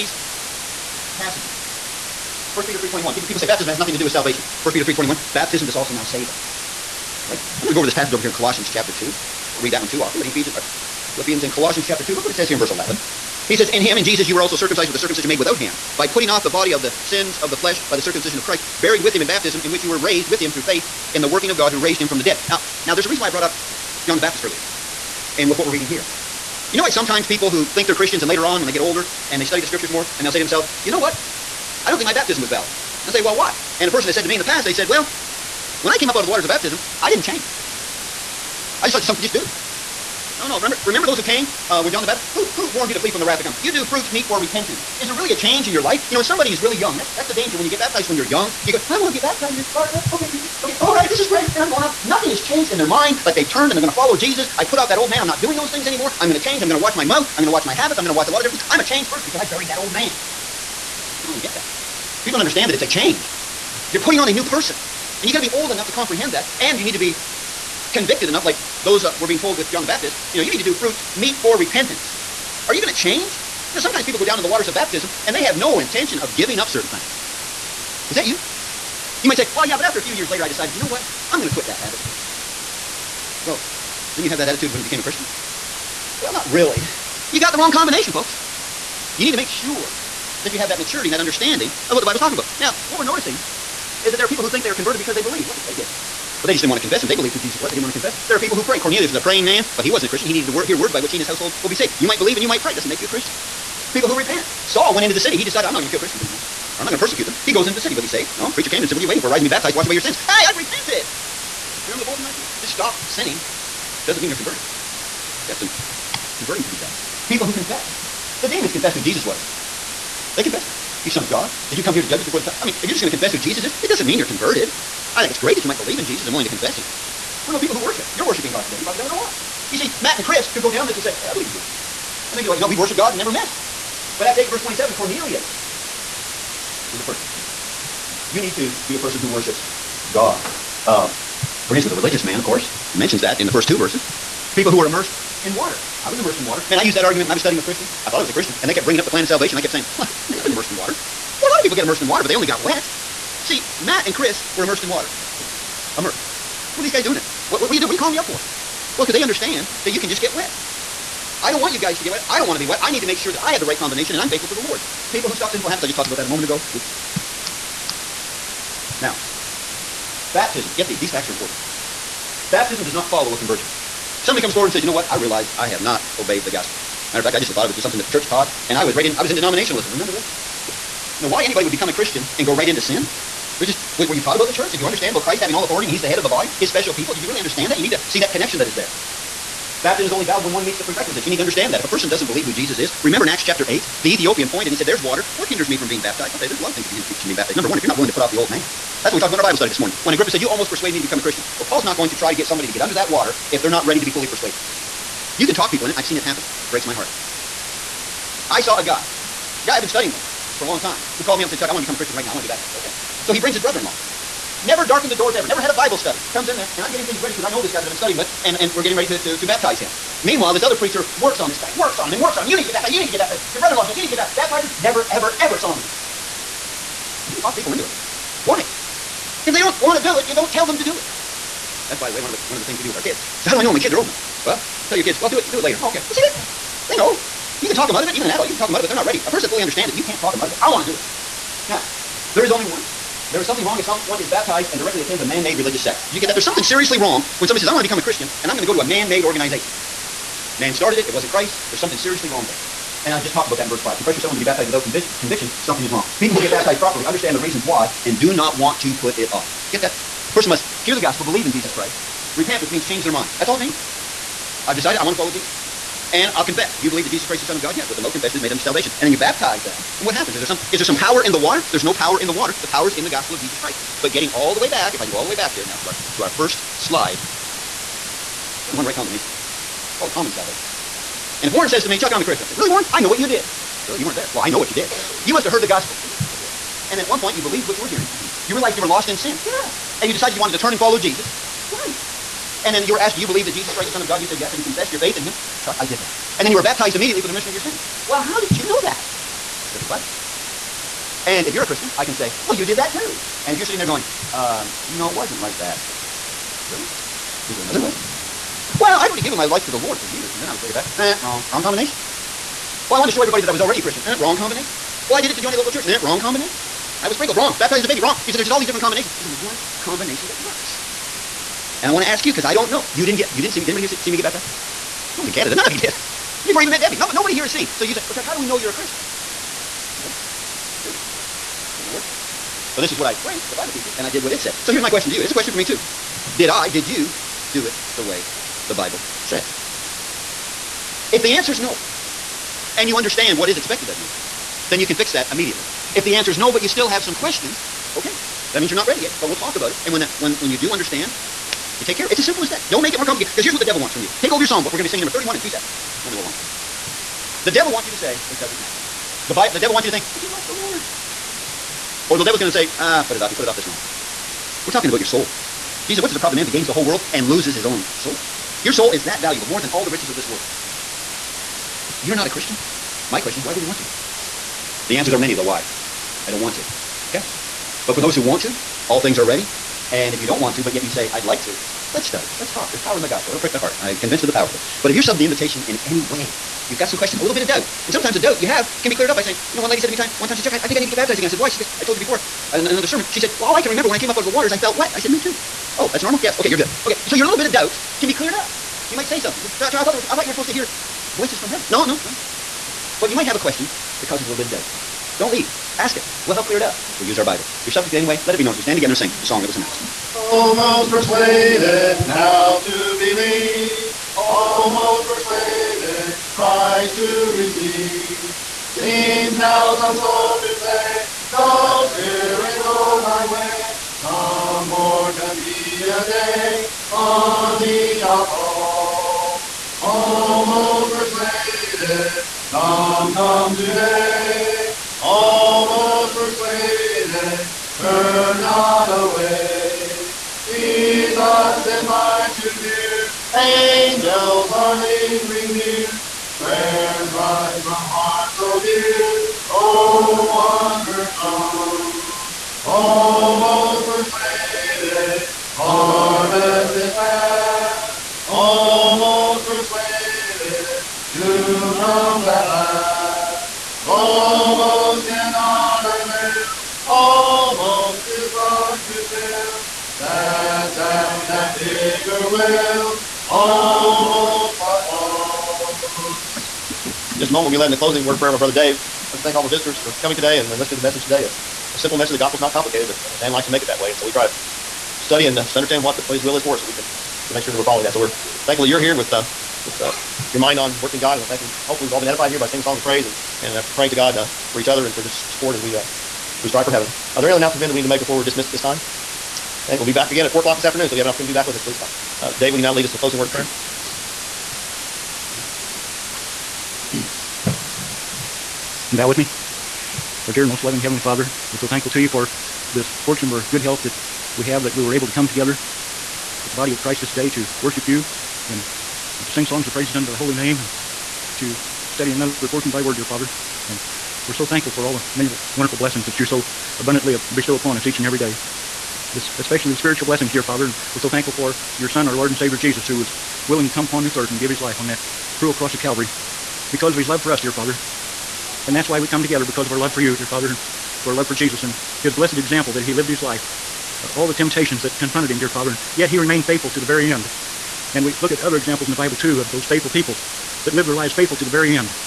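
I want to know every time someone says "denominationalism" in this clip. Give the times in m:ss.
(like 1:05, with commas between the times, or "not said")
2:59.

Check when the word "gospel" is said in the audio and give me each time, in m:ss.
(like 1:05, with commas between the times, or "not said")
2:56, 4:20, 4:33, 4:45, 6:23, 8:02.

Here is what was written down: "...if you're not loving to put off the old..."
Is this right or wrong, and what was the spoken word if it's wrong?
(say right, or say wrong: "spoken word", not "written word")
wrong: "willing", not "loving".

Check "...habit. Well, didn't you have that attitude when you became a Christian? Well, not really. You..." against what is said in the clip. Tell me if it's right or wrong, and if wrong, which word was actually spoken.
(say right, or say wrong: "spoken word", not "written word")
right.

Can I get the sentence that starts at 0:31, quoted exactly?
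I don't think my baptism was valid.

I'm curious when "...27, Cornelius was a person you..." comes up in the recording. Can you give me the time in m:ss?
2:14.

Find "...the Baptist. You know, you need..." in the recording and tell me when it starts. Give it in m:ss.
1:09.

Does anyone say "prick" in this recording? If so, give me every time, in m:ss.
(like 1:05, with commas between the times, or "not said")
6:23.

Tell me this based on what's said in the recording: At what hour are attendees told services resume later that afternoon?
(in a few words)
4 o'clock.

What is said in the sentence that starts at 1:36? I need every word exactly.
But they just didn't want to confess him.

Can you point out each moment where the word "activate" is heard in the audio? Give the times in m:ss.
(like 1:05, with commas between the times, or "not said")
not said.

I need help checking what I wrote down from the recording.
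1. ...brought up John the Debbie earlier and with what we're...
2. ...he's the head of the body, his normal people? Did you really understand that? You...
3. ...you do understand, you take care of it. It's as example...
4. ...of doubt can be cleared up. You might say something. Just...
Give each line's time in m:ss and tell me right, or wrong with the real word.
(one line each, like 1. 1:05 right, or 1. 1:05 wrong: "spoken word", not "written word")
1. 0:23 wrong: "Baptist", not "Debbie"
2. 3:05 wrong: "special", not "normal"
3. 5:50 wrong: "simple", not "example"
4. 6:37 right.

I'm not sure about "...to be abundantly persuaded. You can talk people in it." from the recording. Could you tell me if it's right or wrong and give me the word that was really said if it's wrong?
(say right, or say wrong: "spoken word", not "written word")
wrong: "fully", not "abundantly".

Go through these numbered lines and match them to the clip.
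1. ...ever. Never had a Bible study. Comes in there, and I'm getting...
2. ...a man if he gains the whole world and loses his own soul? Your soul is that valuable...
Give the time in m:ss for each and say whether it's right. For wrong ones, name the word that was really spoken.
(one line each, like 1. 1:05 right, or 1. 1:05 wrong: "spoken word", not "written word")
1. 3:35 right
2. 6:06 right.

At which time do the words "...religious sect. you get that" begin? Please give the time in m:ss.
4:05.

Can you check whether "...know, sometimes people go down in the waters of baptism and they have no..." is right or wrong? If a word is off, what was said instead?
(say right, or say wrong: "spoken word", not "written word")
right.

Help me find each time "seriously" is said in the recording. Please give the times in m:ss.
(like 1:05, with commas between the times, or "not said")
4:06, 4:11.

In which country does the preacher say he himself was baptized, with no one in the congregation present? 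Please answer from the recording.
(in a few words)
Canada.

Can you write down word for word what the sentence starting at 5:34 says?
So here's my question to you.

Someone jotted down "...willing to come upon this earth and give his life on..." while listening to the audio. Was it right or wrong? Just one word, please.
right.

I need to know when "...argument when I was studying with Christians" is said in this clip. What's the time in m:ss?
2:27.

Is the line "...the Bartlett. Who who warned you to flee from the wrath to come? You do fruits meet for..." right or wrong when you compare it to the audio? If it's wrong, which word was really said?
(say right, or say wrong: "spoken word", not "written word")
wrong: "Baptist", not "Bartlett".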